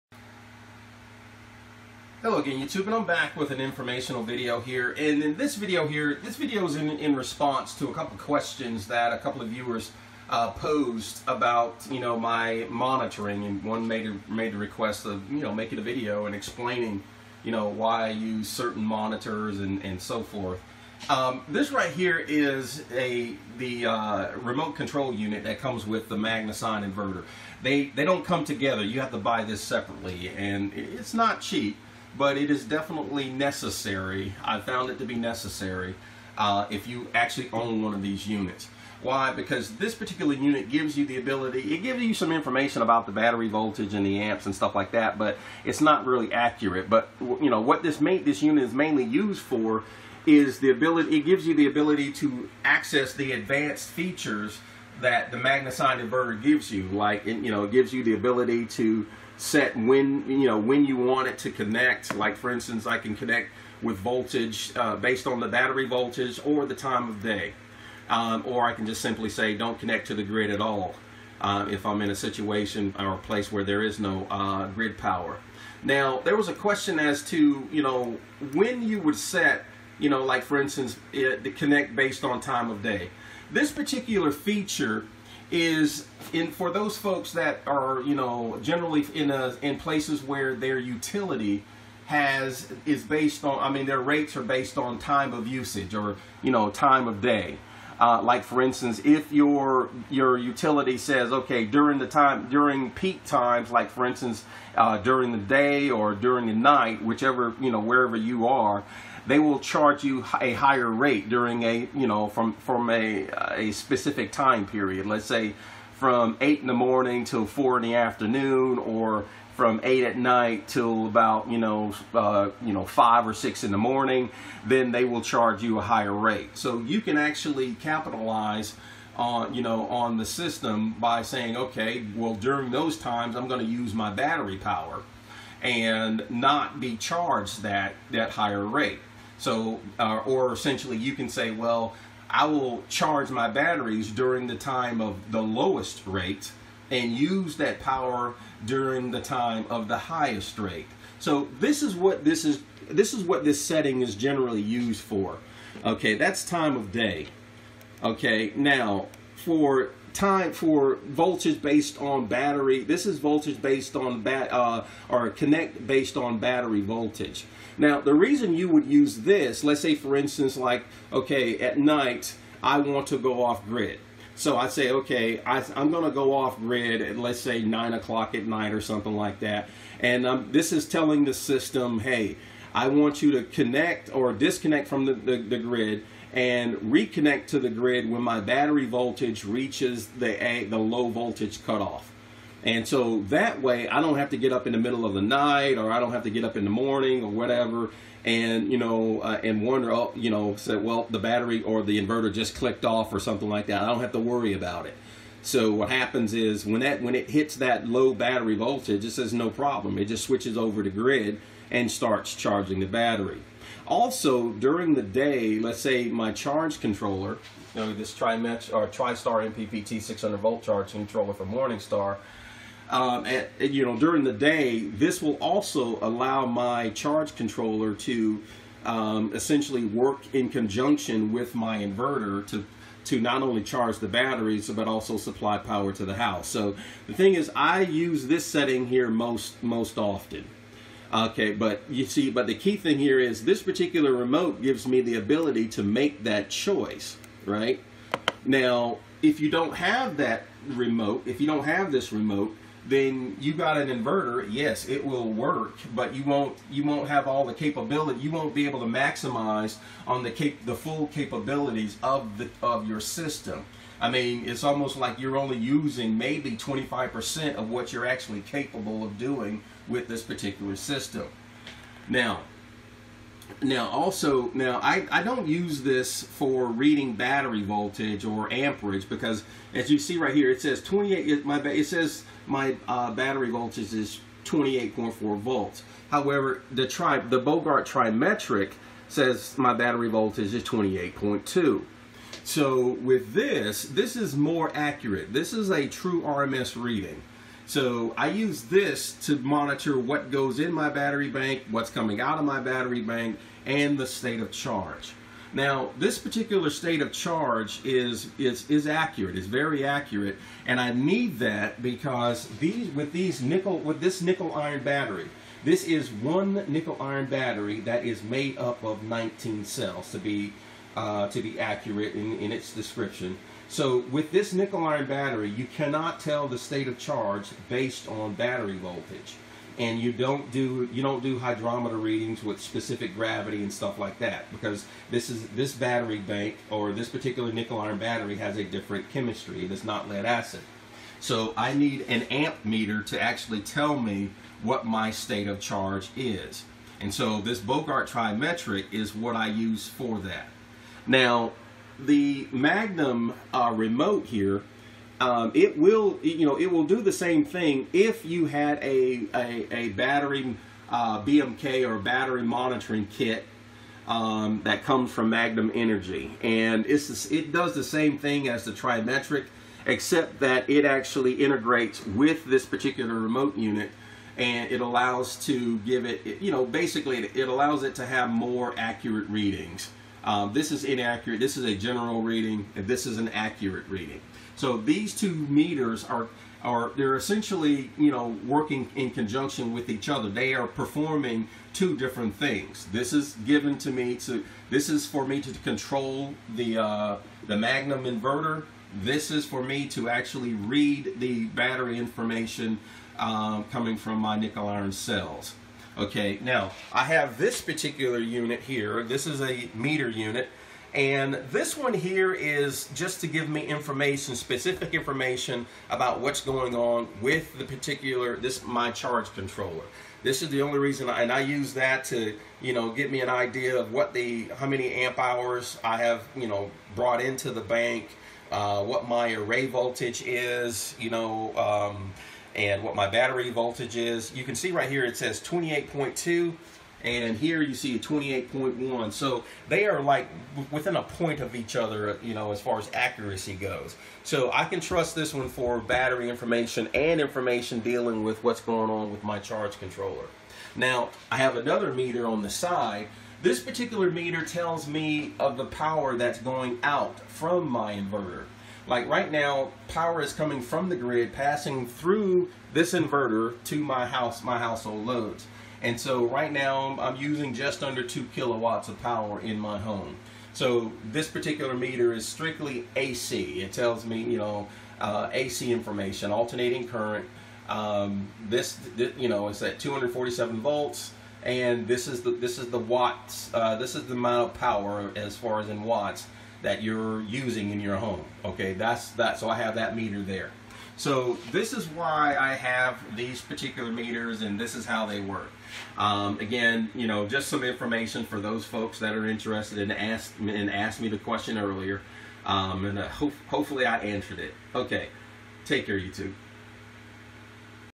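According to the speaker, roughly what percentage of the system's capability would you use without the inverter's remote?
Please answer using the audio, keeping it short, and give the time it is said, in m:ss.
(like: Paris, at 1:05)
25%, at 4:26.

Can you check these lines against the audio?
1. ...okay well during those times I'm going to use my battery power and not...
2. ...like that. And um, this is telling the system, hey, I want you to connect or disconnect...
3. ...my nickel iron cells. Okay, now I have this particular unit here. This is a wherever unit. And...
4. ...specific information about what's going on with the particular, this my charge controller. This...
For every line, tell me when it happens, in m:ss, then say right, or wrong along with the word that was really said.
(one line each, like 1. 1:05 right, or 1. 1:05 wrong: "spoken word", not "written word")
1. 2:11 right
2. 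2:59 right
3. 6:44 wrong: "meter", not "wherever"
4. 6:54 right.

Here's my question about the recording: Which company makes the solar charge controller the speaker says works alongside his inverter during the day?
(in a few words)
Morningstar.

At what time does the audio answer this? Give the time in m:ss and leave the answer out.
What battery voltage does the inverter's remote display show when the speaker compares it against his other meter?
4:44.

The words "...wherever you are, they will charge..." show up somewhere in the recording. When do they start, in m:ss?
1:47.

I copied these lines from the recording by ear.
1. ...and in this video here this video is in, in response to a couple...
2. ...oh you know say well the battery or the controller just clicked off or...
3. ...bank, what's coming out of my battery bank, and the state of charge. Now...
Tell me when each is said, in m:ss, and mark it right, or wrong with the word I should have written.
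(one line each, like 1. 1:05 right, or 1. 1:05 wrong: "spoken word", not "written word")
1. 0:04 right
2. 3:19 wrong: "inverter", not "controller"
3. 5:01 right.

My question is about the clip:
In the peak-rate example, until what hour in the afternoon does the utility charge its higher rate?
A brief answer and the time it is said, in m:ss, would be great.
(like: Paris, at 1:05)
4, at 1:57.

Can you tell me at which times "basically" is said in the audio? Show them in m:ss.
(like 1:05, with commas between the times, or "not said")
6:16.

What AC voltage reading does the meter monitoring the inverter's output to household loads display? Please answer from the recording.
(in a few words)
247 volts.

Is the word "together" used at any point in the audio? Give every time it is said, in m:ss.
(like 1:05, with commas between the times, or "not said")
0:28.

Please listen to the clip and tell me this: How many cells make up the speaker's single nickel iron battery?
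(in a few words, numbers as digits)
19.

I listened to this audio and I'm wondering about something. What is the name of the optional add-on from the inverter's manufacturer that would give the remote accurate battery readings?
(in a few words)
battery monitoring kit.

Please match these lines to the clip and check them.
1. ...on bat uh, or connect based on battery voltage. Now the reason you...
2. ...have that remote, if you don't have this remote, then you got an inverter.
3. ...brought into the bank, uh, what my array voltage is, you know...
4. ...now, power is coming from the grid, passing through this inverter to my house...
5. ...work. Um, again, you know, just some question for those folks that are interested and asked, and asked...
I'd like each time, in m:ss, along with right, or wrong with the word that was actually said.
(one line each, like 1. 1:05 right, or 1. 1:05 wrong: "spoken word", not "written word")
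1. 2:43 right
2. 4:09 right
3. 7:06 right
4. 7:39 right
5. 8:15 wrong: "information", not "question".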